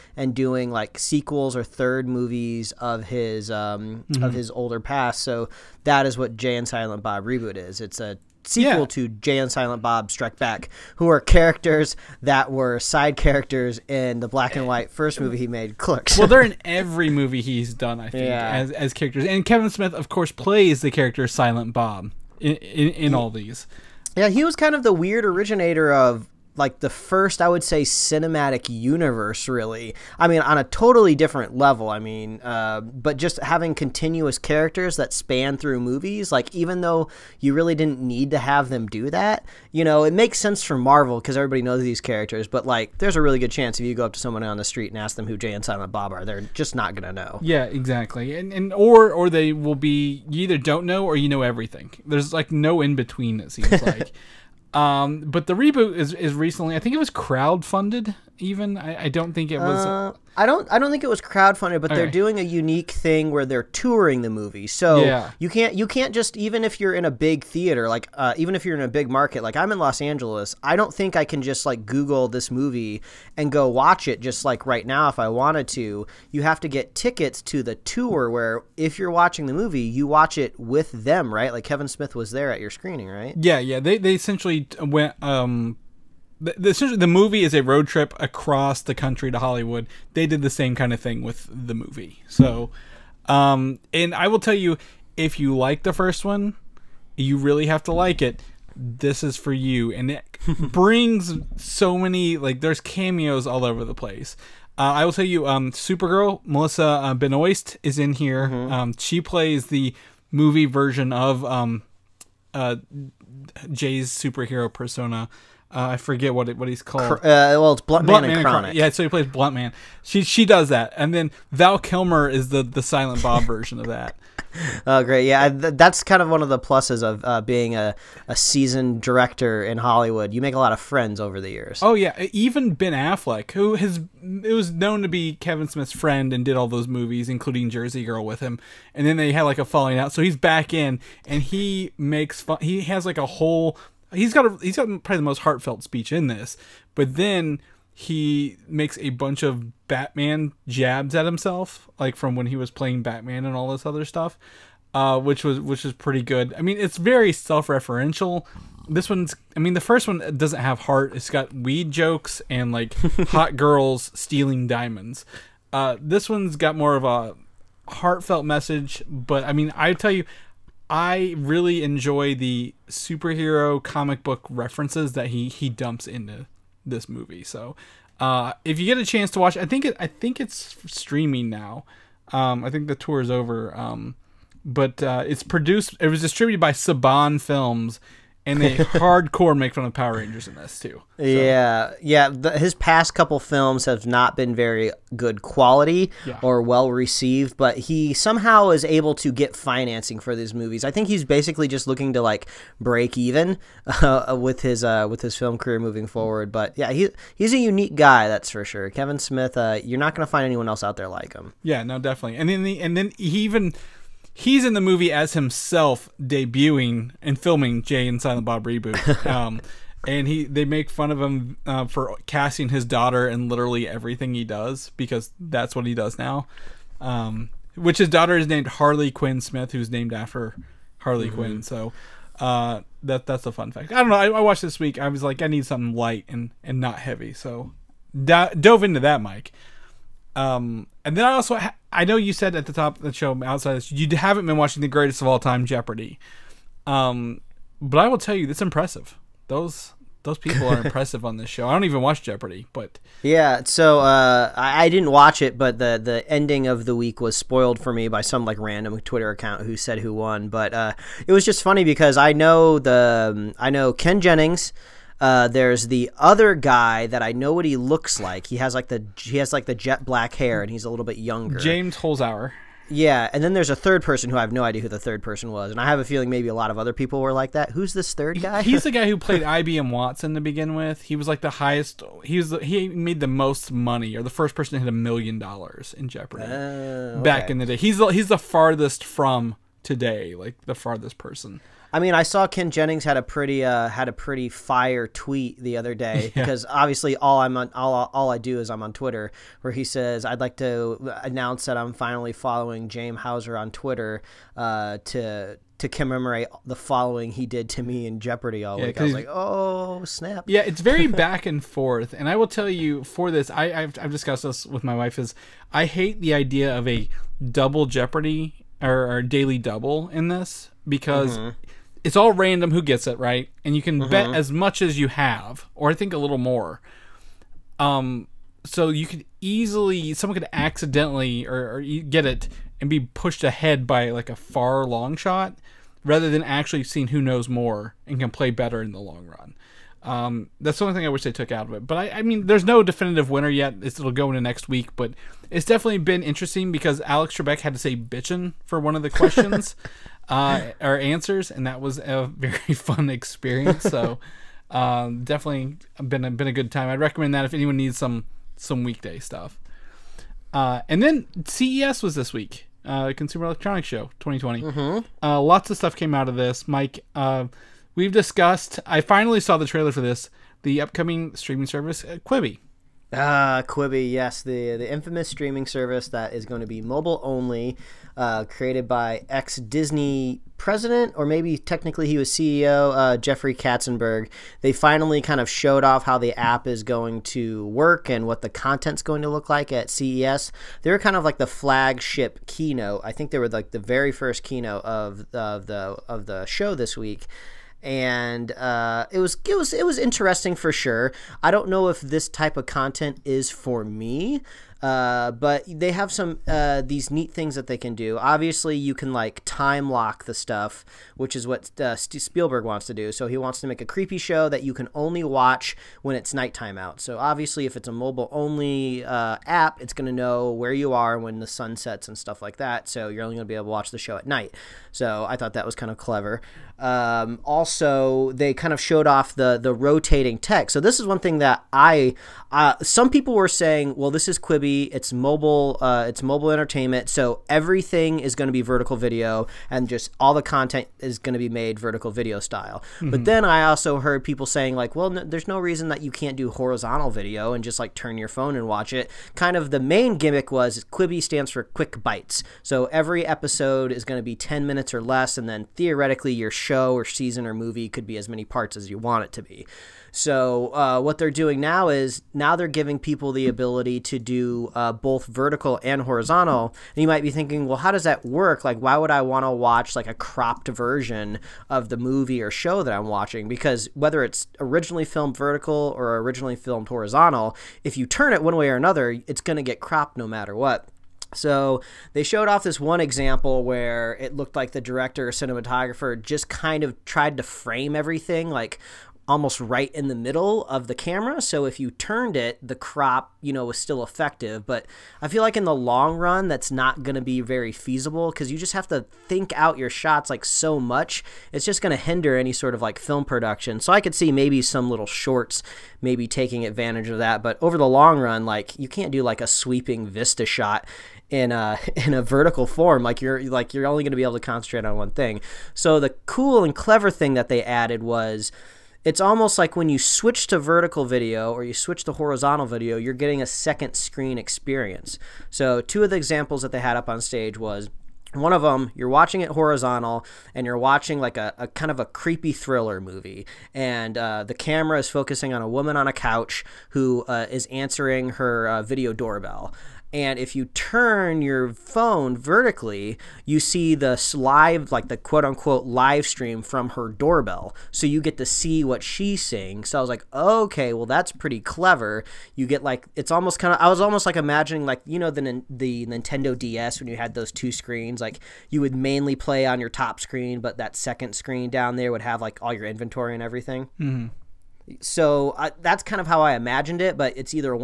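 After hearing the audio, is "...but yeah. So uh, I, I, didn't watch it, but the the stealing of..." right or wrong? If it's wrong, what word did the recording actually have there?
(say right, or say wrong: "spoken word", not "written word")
wrong: "ending", not "stealing".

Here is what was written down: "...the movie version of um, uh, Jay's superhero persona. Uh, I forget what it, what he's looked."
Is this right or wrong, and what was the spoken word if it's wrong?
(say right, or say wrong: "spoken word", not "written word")
wrong: "called", not "looked".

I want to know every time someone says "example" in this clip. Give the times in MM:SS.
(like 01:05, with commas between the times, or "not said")
08:02, 08:46.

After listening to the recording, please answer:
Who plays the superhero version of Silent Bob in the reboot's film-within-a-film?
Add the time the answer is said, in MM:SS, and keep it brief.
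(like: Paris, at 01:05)
Val Kilmer, at 02:01.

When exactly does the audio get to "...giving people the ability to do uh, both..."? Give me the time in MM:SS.
07:42.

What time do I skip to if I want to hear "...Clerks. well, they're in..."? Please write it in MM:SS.
00:15.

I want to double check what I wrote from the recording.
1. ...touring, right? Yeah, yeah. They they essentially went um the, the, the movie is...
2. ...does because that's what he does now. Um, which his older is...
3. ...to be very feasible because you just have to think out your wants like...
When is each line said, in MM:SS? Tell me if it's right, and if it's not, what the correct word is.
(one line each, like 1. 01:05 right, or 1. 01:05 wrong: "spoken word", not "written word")
1. 01:22 wrong: "screening", not "touring"
2. 03:44 wrong: "daughter", not "older"
3. 08:17 wrong: "shots", not "wants".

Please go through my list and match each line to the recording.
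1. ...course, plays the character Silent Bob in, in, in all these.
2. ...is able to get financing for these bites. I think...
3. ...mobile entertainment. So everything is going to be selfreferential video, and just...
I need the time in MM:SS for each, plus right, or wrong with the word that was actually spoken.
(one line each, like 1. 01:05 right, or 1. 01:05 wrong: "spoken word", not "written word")
1. 00:20 right
2. 03:18 wrong: "movies", not "bites"
3. 07:16 wrong: "vertical", not "selfreferential".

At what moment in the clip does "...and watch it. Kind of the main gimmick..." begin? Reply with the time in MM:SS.
07:28.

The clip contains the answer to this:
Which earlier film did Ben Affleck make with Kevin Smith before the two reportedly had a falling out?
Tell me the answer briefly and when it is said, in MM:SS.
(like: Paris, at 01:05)
Jersey Girl, at 02:17.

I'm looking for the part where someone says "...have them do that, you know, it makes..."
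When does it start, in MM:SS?
00:38.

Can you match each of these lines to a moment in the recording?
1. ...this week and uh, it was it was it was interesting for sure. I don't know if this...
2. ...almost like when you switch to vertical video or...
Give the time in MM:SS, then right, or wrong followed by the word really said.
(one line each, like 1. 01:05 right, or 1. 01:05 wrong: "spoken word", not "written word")
1. 06:36 right
2. 08:39 right.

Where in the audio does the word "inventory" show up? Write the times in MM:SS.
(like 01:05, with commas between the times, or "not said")
09:22.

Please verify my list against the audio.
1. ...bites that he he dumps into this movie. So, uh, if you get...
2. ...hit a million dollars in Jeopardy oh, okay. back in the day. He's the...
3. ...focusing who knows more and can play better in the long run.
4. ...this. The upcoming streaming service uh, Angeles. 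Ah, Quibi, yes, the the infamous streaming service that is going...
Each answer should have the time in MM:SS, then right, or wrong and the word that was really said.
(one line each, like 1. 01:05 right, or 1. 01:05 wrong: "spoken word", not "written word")
1. 02:54 wrong: "references", not "bites"
2. 04:44 right
3. 05:36 wrong: "seeing", not "focusing"
4. 06:10 wrong: "Quibi", not "Angeles".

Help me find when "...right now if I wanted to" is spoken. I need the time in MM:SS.
01:14.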